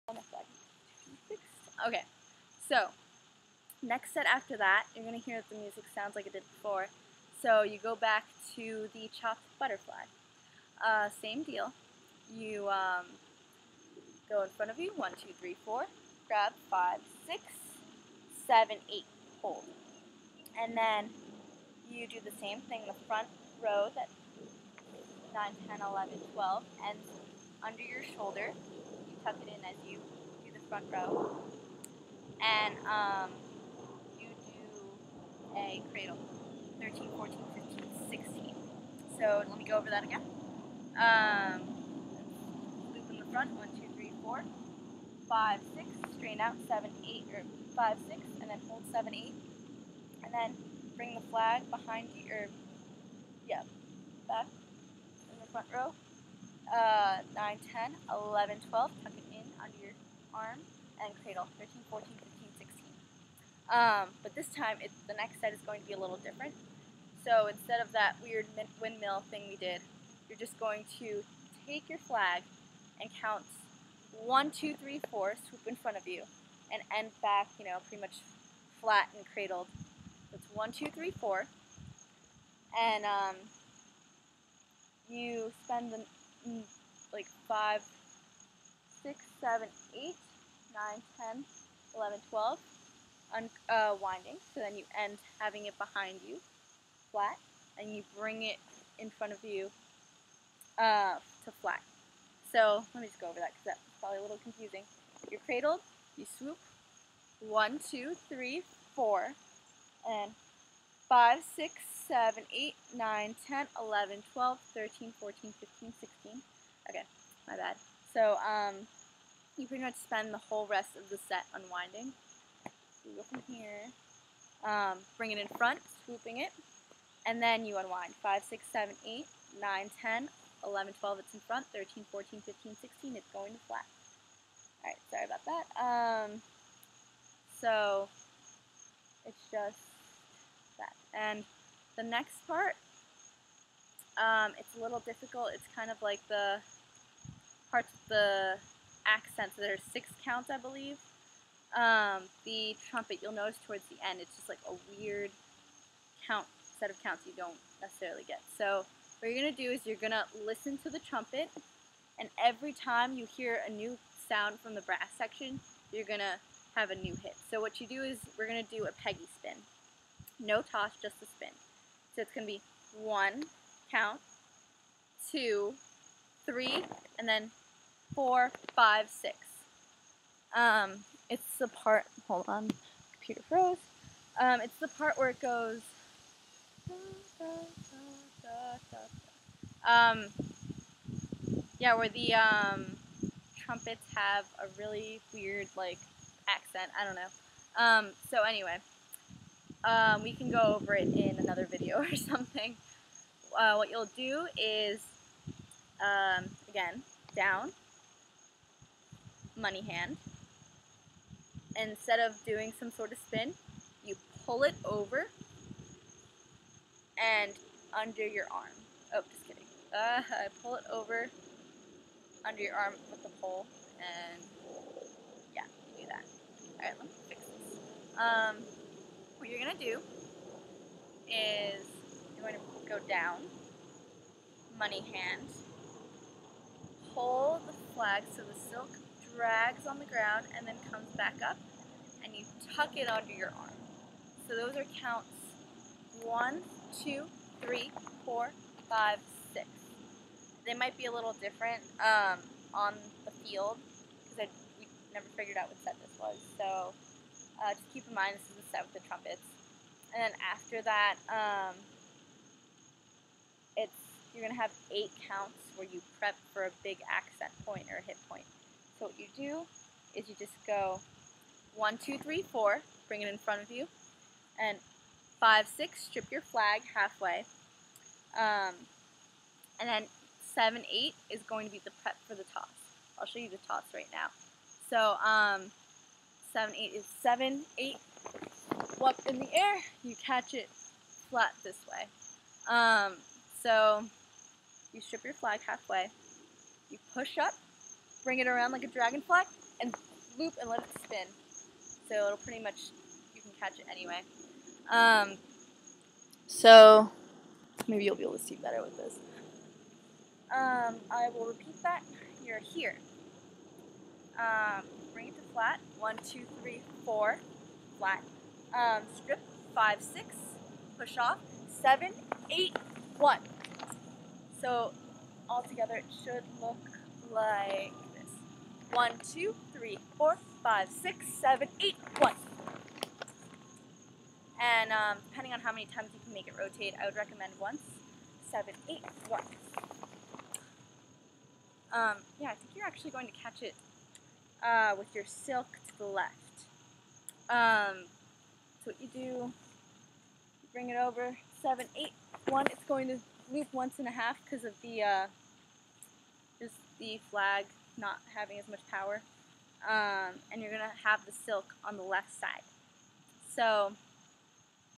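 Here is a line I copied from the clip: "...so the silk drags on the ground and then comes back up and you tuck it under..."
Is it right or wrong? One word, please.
right.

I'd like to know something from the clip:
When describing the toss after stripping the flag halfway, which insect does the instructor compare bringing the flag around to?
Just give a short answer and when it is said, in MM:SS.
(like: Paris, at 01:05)
dragonfly, at 04:58.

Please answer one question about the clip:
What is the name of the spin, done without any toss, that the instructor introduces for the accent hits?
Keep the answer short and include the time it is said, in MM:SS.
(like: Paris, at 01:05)
Peggy spin, at 02:49.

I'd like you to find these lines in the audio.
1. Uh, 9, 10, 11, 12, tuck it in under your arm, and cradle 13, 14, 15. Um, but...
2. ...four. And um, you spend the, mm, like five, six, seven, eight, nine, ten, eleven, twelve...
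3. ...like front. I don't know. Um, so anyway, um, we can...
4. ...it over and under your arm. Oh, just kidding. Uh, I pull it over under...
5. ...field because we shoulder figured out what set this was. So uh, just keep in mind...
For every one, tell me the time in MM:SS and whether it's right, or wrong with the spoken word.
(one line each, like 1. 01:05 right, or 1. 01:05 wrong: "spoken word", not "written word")
1. 00:56 right
2. 01:21 right
3. 03:15 wrong: "accent", not "front"
4. 03:34 right
5. 04:13 wrong: "never", not "shoulder".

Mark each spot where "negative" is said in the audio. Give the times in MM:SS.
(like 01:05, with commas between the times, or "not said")
not said.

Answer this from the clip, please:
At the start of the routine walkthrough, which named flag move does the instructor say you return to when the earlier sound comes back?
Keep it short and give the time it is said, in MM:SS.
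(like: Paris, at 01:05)
chopped butterfly, at 00:09.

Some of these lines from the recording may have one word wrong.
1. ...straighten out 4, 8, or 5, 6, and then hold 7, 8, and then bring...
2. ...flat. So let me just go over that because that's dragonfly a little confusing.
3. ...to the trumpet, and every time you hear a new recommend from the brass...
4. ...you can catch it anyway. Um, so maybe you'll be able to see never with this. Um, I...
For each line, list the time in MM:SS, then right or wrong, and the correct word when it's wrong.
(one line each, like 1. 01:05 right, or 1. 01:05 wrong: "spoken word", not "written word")
1. 00:46 wrong: "7", not "4"
2. 01:41 wrong: "probably", not "dragonfly"
3. 02:40 wrong: "sound", not "recommend"
4. 05:03 wrong: "better", not "never".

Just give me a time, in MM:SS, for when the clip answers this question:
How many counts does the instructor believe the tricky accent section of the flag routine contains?
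02:29.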